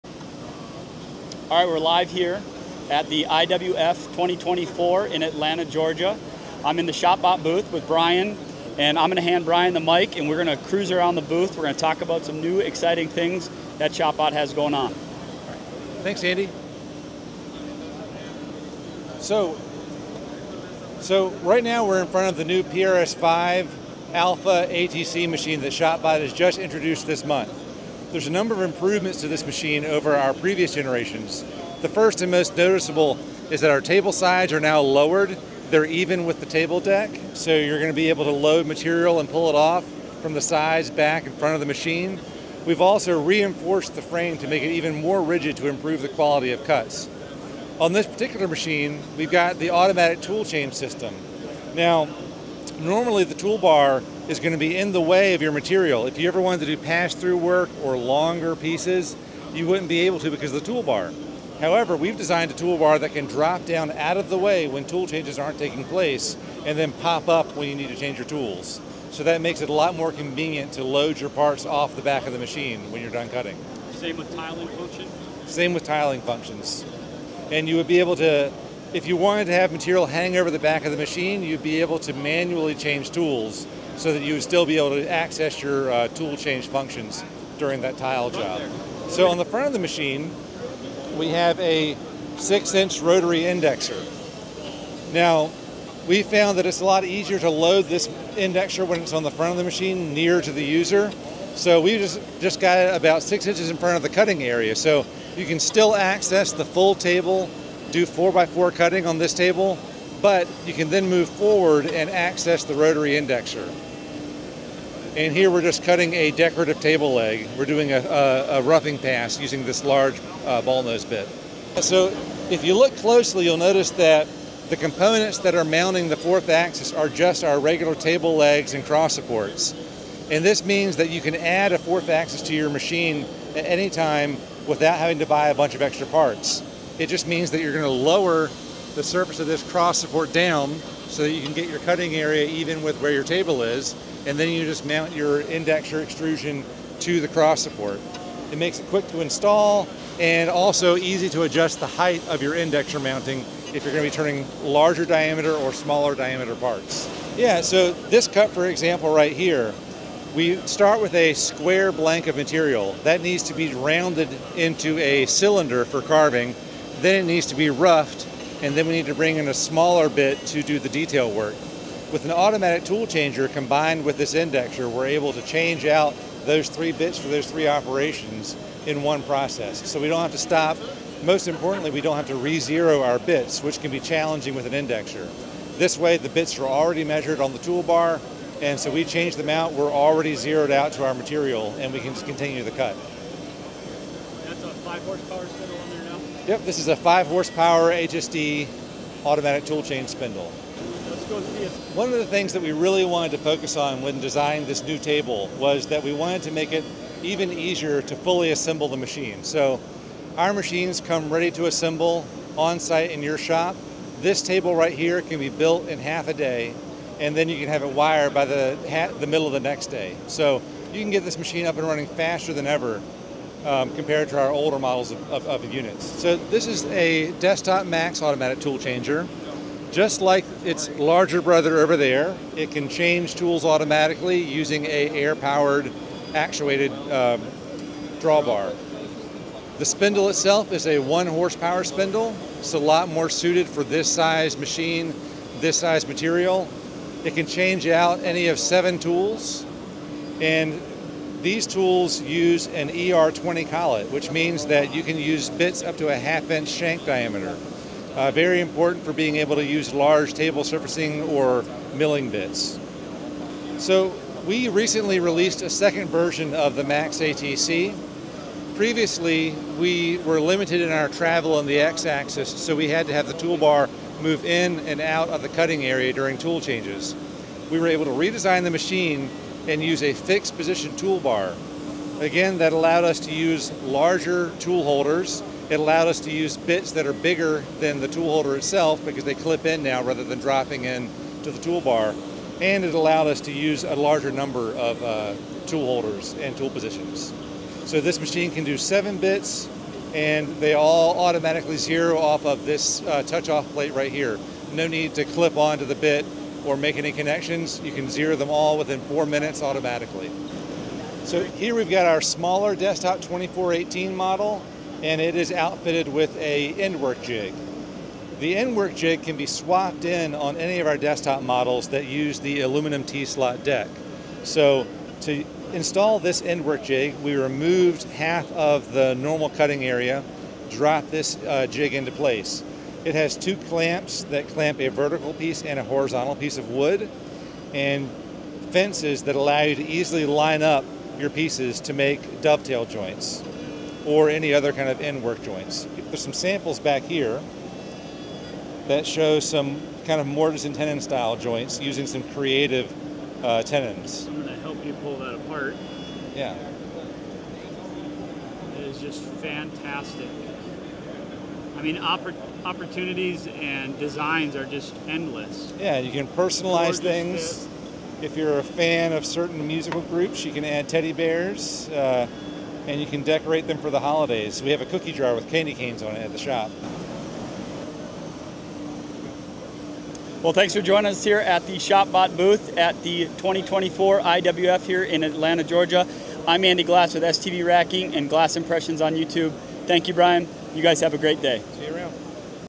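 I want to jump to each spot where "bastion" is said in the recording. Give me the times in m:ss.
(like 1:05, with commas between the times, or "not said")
not said.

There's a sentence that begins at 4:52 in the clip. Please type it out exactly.
And it allowed us to use a larger number of uh, tool holders and tool positions.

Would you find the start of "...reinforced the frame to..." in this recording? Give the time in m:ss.
0:43.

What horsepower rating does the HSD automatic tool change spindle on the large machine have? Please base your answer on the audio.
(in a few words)
5 horsepower.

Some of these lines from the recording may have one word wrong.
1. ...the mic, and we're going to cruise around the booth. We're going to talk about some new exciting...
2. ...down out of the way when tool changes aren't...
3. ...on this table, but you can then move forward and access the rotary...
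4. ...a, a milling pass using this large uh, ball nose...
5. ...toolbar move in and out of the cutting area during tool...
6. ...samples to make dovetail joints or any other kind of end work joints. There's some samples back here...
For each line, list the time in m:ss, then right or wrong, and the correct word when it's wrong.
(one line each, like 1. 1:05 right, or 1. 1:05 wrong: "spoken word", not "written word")
1. 0:09 right
2. 1:03 right
3. 1:49 right
4. 1:57 wrong: "roughing", not "milling"
5. 4:33 right
6. 5:41 wrong: "pieces", not "samples".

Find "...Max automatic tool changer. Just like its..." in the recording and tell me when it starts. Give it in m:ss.
3:47.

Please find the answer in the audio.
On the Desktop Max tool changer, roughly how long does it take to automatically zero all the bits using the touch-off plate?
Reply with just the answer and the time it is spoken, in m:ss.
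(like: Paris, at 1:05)
4 minutes, at 5:09.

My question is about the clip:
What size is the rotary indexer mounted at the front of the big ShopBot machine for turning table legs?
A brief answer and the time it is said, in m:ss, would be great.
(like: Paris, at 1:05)
6 inch, at 1:32.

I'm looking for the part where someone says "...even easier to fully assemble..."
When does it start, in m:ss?
3:27.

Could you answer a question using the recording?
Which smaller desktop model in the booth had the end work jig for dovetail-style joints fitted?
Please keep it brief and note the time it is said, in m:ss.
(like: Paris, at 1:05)
2418, at 5:13.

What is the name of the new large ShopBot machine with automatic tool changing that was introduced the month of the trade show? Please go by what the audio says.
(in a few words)
PRS5 Alpha ATC.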